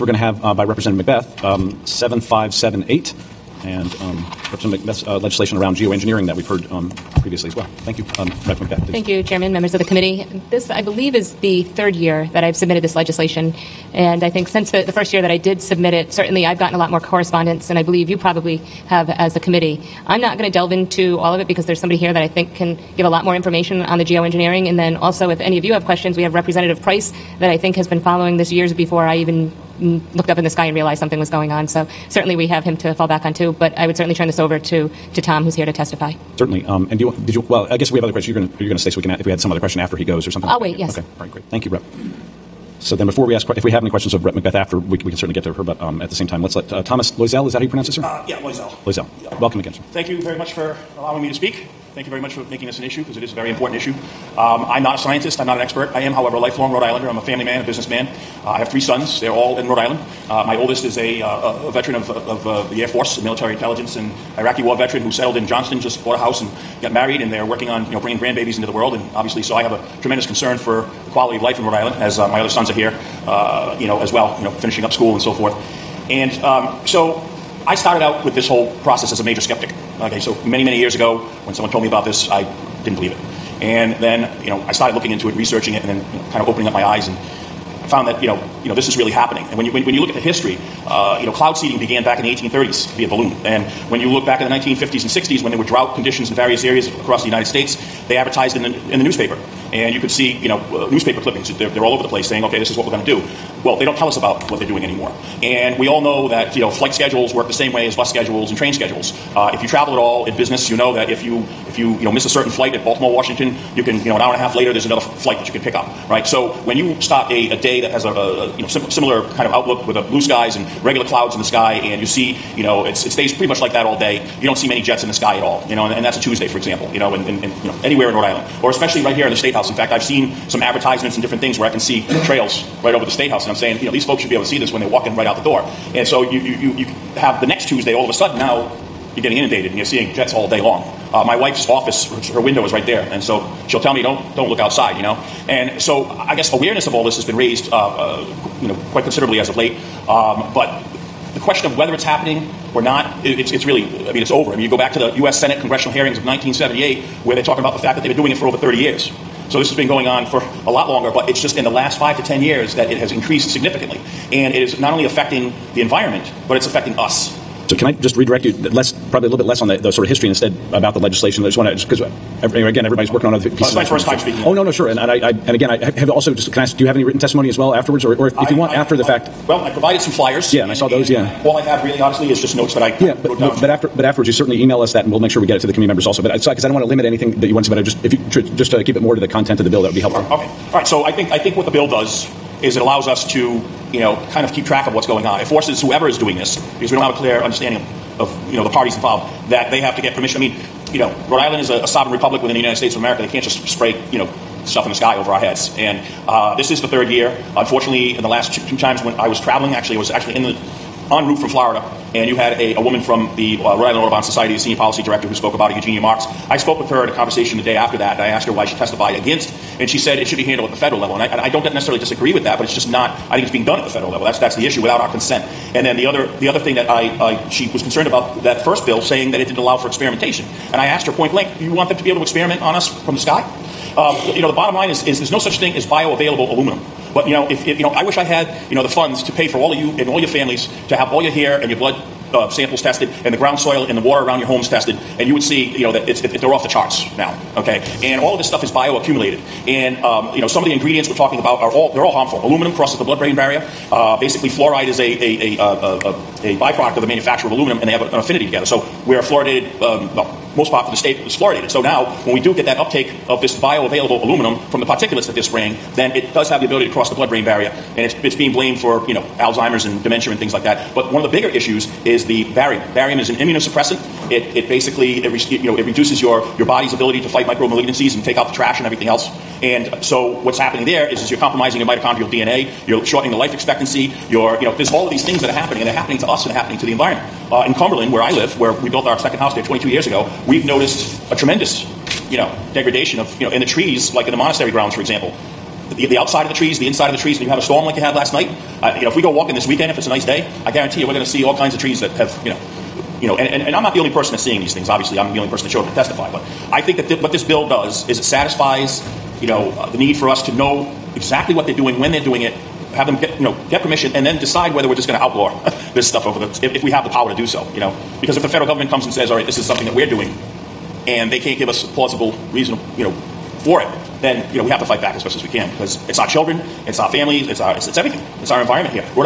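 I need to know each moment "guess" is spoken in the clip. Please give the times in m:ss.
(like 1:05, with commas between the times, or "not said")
0:37, 2:26.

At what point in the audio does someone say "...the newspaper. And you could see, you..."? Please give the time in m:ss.
1:38.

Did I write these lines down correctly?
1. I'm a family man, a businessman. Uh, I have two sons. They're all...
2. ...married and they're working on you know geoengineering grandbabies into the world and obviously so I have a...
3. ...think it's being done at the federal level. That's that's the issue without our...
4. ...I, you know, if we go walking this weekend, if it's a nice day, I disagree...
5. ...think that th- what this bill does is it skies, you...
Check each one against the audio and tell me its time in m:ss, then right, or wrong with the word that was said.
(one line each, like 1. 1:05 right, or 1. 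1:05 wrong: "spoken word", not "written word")
1. 0:57 wrong: "three", not "two"
2. 1:06 wrong: "bringing", not "geoengineering"
3. 3:43 right
4. 4:58 wrong: "guarantee", not "disagree"
5. 5:06 wrong: "satisfies", not "skies".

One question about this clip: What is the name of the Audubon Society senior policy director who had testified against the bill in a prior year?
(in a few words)
Eugenia Marks.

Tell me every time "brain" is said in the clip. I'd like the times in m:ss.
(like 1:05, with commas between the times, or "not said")
4:13, 4:27.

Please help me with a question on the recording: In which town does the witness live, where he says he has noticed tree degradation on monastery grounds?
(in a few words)
Cumberland.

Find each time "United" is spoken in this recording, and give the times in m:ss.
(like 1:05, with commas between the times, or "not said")
1:37, 3:22.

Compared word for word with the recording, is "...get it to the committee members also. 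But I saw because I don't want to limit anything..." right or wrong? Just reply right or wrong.
right.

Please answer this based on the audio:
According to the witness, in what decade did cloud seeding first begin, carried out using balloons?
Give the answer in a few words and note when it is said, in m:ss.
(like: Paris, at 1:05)
1830s, at 1:32.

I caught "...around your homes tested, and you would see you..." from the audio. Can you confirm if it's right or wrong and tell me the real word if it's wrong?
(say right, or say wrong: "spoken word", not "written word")
right.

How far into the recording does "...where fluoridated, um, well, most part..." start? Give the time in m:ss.
4:19.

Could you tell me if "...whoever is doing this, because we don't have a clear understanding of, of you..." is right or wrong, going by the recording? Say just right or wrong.
right.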